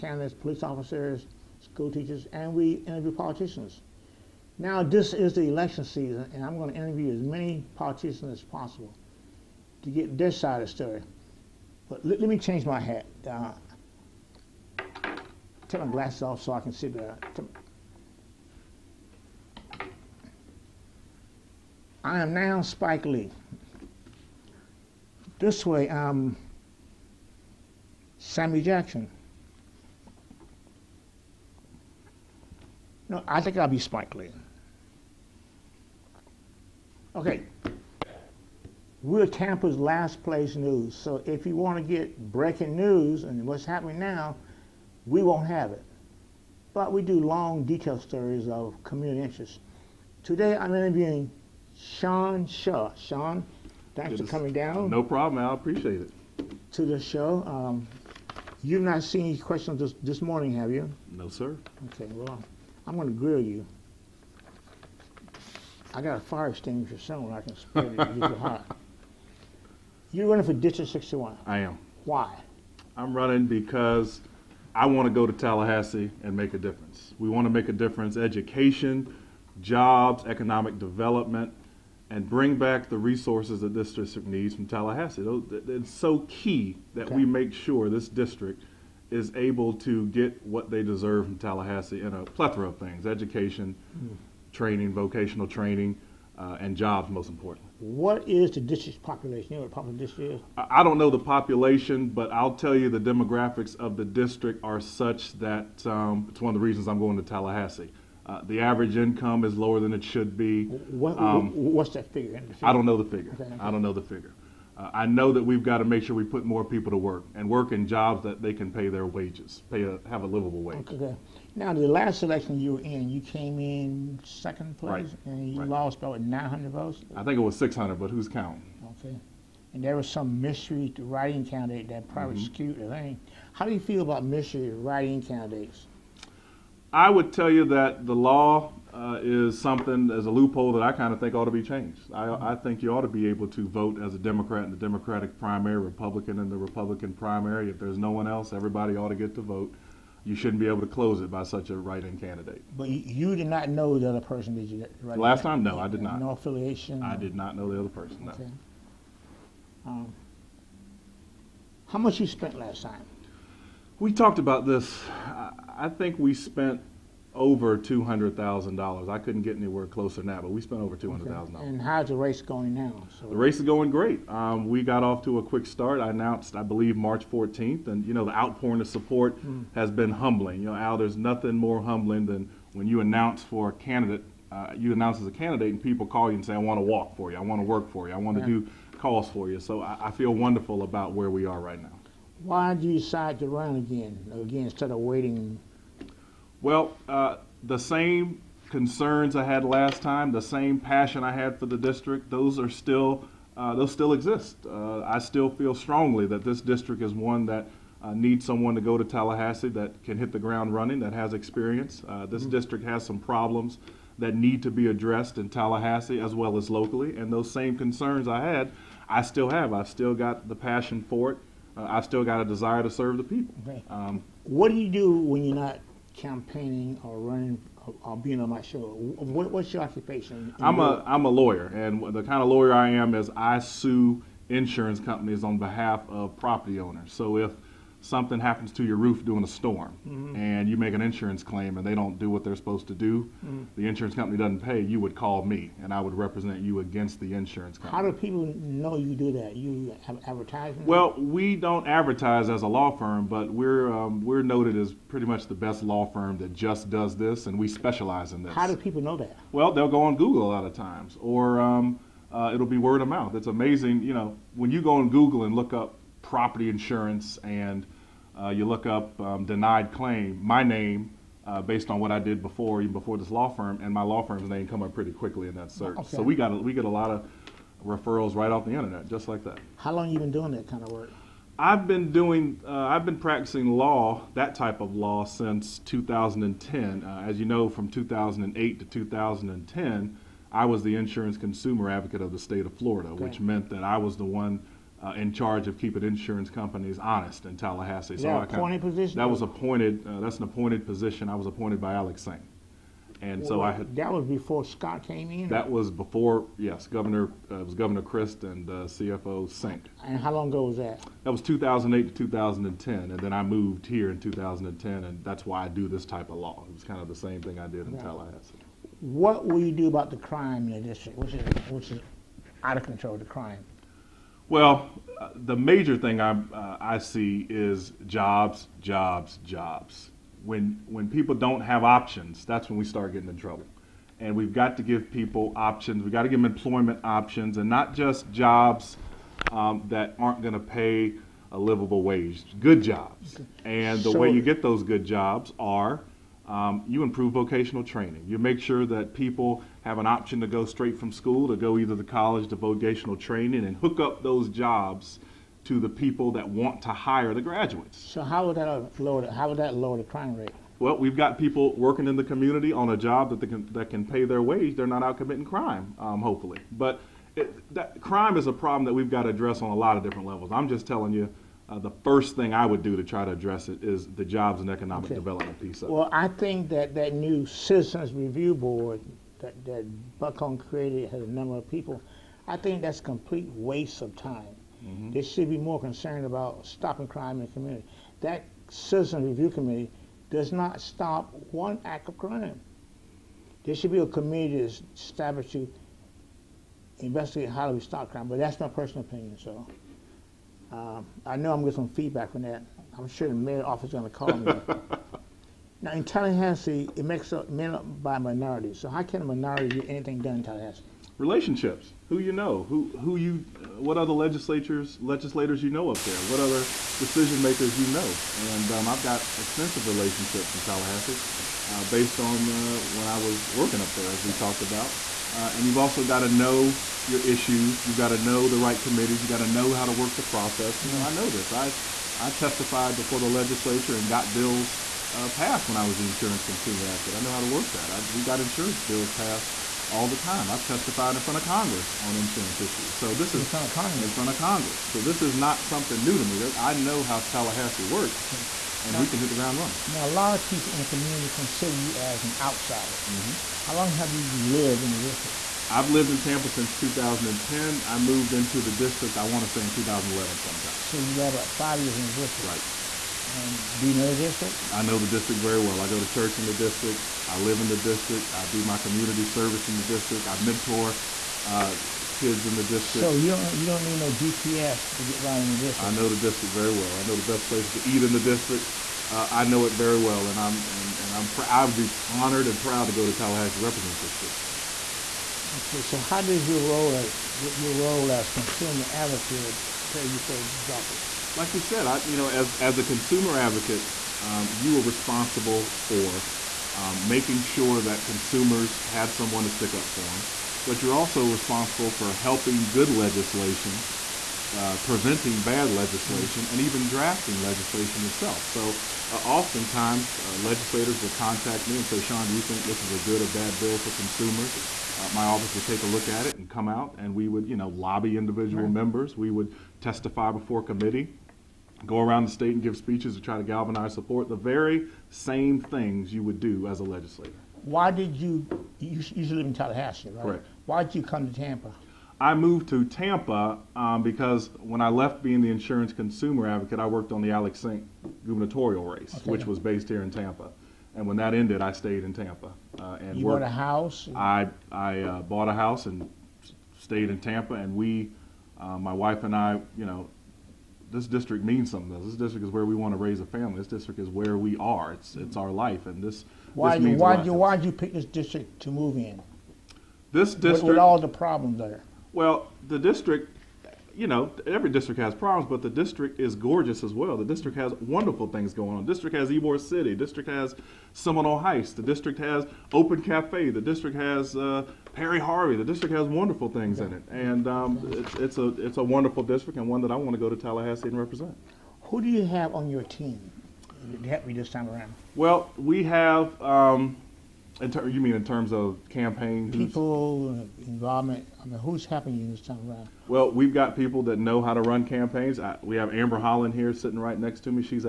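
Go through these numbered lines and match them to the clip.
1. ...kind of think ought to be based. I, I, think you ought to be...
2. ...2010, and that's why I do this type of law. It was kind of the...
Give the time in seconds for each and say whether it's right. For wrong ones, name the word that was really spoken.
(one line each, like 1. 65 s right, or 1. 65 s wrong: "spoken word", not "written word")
1. 140 s wrong: "changed", not "based"
2. 314 s right.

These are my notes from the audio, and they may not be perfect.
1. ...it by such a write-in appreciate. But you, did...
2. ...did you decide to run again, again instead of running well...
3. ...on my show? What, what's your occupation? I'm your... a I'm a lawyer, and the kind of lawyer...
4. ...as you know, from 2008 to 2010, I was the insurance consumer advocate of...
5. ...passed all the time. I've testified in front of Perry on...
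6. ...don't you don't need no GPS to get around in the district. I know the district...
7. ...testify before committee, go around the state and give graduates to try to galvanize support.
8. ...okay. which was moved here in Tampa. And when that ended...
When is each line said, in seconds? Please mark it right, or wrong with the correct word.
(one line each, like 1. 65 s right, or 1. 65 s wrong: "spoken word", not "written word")
1. 151 s wrong: "candidate", not "appreciate"
2. 192 s wrong: "waiting", not "running"
3. 228 s right
4. 287 s right
5. 439 s wrong: "Congress", not "Perry"
6. 473 s right
7. 519 s wrong: "speeches", not "graduates"
8. 539 s wrong: "based", not "moved".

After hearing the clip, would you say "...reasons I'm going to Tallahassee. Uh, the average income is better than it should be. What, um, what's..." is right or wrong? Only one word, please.
wrong.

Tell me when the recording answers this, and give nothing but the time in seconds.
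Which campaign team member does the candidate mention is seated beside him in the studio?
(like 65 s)
595 s.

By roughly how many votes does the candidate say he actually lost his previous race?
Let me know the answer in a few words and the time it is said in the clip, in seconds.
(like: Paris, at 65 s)
600, at 127 s.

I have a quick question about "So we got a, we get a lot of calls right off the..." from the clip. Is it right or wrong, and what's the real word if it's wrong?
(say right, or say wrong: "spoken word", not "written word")
wrong: "referrals", not "calls".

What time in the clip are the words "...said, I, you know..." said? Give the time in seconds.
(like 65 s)
491 s.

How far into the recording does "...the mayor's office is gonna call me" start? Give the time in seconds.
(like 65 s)
403 s.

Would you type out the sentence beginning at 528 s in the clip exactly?
You, you live in Tallahassee, right?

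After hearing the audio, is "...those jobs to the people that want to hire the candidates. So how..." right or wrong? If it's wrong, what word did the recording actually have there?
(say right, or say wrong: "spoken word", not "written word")
wrong: "graduates", not "candidates".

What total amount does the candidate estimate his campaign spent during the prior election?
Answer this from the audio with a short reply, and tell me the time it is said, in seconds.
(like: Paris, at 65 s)
Over $200,000, at 167 s.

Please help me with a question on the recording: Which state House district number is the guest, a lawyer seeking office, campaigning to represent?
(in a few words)
61.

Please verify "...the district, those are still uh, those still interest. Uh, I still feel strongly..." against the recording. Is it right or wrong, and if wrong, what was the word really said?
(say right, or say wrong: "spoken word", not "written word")
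wrong: "exist", not "interest".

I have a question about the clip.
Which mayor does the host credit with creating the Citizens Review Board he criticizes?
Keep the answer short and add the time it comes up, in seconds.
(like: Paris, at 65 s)
Buckhorn, at 380 s.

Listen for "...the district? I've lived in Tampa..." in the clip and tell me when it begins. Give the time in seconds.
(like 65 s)
454 s.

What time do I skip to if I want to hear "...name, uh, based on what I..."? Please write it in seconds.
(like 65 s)
270 s.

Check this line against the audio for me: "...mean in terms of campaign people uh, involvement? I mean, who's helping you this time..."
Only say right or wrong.
right.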